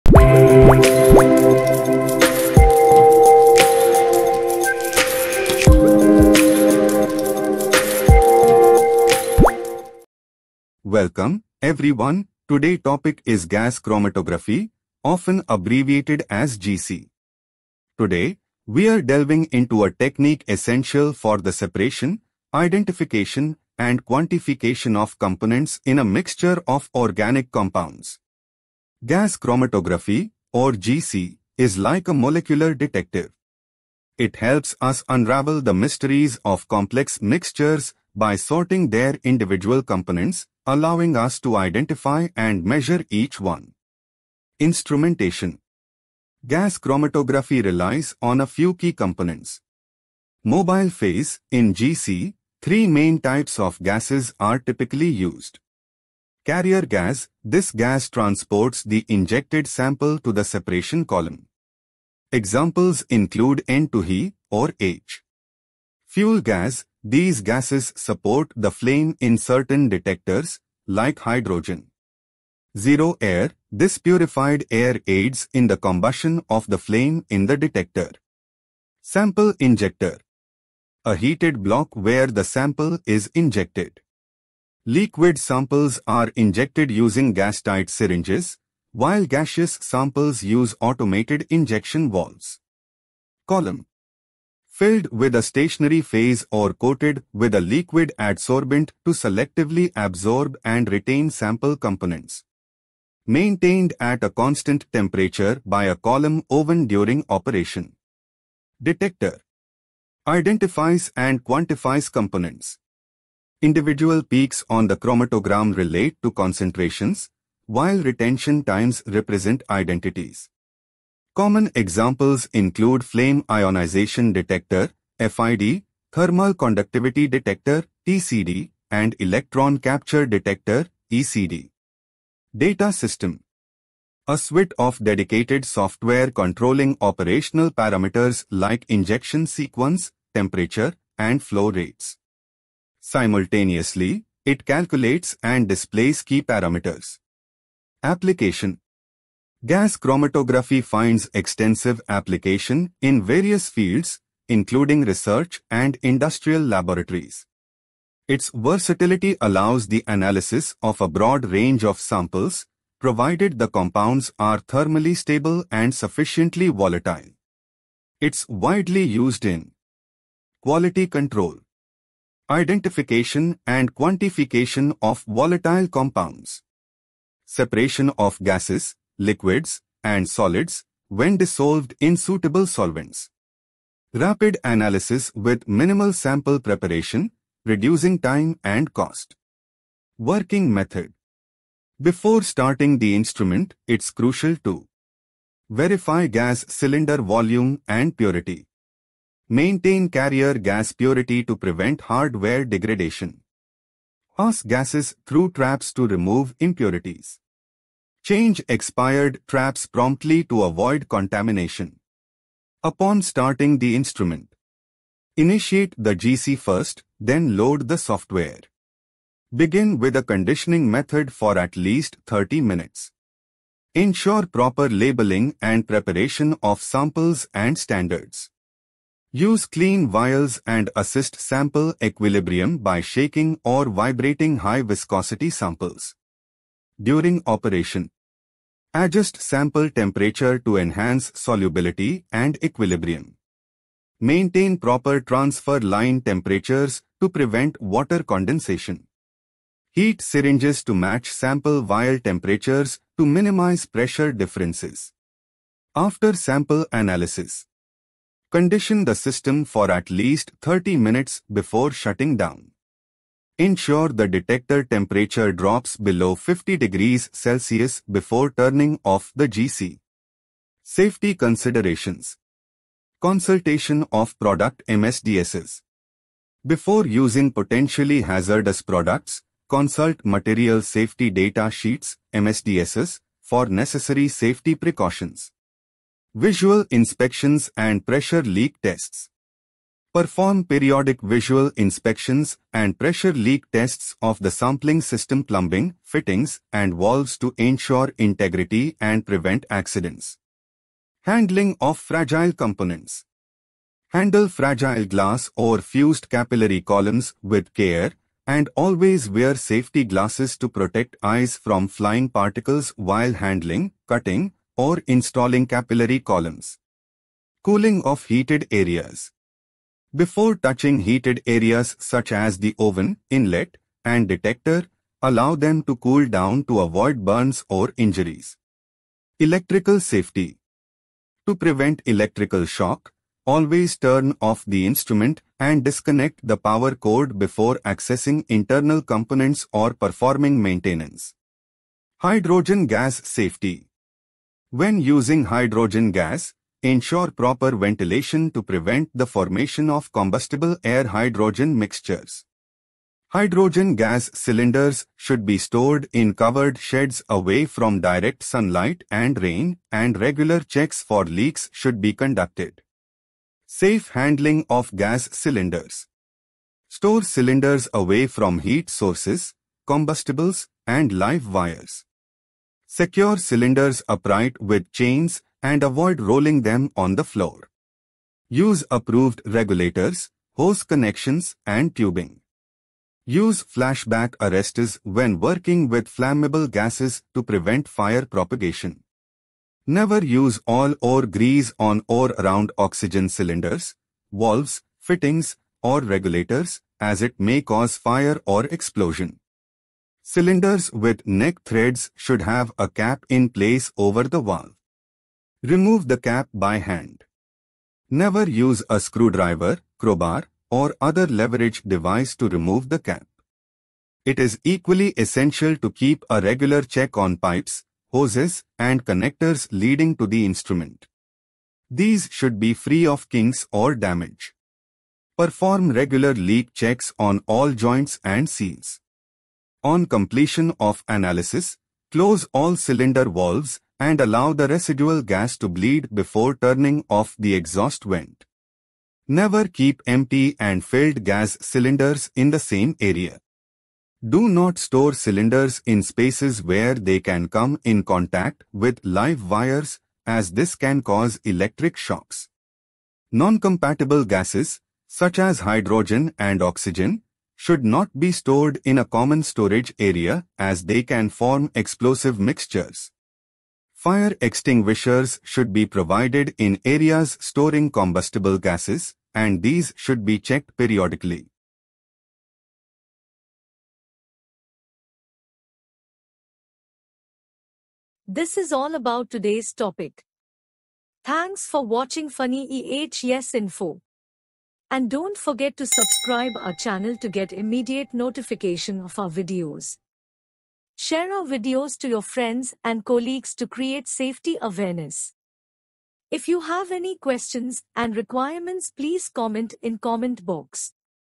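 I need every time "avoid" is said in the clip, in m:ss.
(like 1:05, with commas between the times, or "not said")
3:30, 5:26, 6:15.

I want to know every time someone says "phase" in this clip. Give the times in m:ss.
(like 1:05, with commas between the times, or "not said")
0:50, 1:36.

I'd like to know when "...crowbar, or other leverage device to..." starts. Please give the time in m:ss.
6:49.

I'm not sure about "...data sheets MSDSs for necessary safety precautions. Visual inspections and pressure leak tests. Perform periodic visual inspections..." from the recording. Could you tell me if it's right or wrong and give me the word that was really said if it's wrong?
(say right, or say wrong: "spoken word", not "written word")
right.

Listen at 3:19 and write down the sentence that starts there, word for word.
Maintain carrier gas purity to prevent hardware degradation.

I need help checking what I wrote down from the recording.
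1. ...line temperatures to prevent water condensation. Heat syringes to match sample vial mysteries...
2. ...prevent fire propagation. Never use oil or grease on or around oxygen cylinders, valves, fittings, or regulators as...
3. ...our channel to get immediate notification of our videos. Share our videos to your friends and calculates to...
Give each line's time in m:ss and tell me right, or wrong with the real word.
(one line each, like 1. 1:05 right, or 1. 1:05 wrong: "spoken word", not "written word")
1. 4:05 wrong: "temperatures", not "mysteries"
2. 6:27 right
3. 8:06 wrong: "colleagues", not "calculates".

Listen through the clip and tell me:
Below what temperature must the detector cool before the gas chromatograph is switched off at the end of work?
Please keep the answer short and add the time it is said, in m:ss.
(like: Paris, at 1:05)
50 degrees Celsius, at 4:26.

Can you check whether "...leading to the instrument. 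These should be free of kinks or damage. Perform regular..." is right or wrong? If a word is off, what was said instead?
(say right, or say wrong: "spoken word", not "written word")
right.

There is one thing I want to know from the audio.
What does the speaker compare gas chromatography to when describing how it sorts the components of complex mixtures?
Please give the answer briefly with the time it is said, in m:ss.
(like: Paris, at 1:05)
A molecular detective, at 0:32.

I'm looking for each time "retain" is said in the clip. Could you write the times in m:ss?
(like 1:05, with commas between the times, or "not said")
1:40.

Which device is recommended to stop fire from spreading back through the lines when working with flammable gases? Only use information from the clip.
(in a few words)
Flashback arresters.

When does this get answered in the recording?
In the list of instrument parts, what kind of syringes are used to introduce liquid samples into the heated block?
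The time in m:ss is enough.
1:27.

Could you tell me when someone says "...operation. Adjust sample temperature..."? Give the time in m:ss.
3:57.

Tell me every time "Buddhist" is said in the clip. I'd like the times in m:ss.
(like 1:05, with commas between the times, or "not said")
not said.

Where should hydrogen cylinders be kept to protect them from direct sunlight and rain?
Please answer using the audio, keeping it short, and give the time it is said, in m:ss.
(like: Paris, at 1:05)
Covered sheds, at 5:56.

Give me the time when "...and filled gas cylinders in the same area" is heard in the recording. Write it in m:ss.
7:20.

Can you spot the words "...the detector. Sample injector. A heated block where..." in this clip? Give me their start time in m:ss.
1:17.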